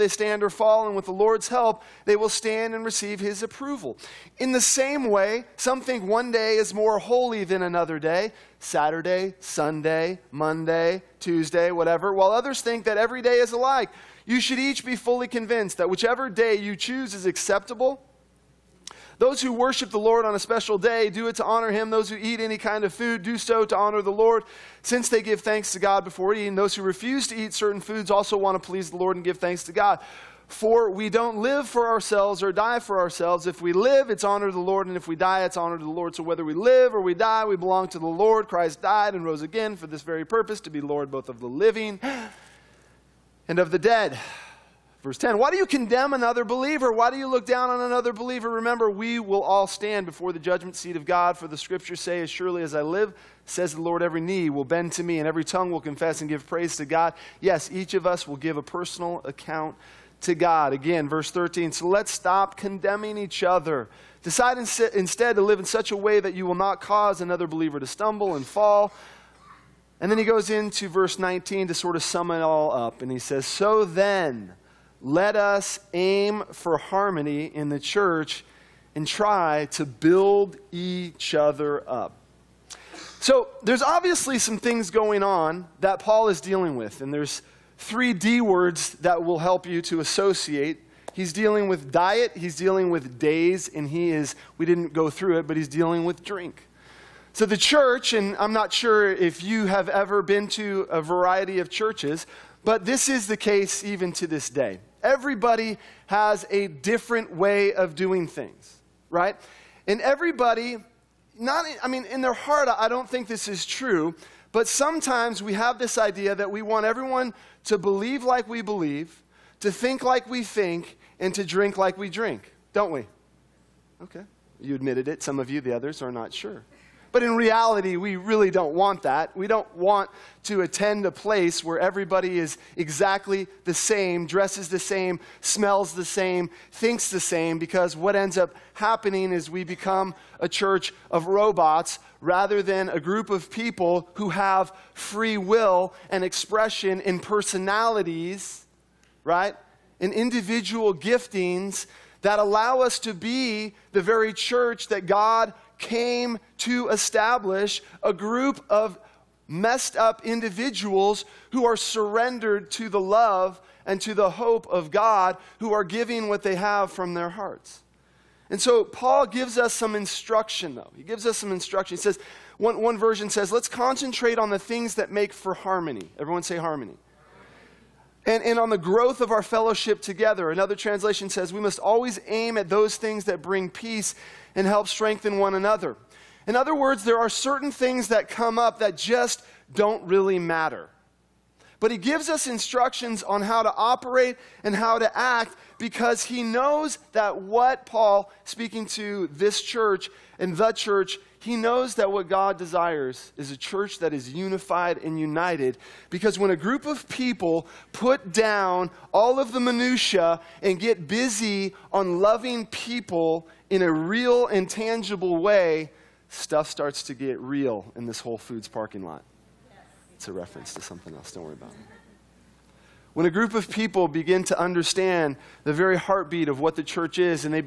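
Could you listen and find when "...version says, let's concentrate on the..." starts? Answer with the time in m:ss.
2:52.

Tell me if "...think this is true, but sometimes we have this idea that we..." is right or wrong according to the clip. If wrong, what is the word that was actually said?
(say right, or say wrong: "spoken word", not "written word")
right.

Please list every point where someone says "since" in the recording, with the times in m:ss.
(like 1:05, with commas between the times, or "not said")
0:24.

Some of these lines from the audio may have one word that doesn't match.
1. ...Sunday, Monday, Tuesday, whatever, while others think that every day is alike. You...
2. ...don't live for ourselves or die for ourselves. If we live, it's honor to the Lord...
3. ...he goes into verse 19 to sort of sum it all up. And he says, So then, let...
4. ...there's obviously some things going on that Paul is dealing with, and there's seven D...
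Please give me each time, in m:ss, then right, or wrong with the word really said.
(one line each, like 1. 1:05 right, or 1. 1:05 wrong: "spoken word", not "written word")
1. 0:09 right
2. 0:31 right
3. 1:10 right
4. 1:23 wrong: "three", not "seven".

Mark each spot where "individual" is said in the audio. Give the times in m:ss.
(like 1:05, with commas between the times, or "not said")
2:30, 2:40.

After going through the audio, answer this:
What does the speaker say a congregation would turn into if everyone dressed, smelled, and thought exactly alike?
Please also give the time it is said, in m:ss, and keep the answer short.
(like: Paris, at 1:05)
a church of robots, at 2:20.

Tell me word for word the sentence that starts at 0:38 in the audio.
Christ died and rose again for this very purpose to be Lord both of the living and of the dead.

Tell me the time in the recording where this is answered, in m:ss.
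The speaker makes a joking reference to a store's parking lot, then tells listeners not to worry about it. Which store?
3:38.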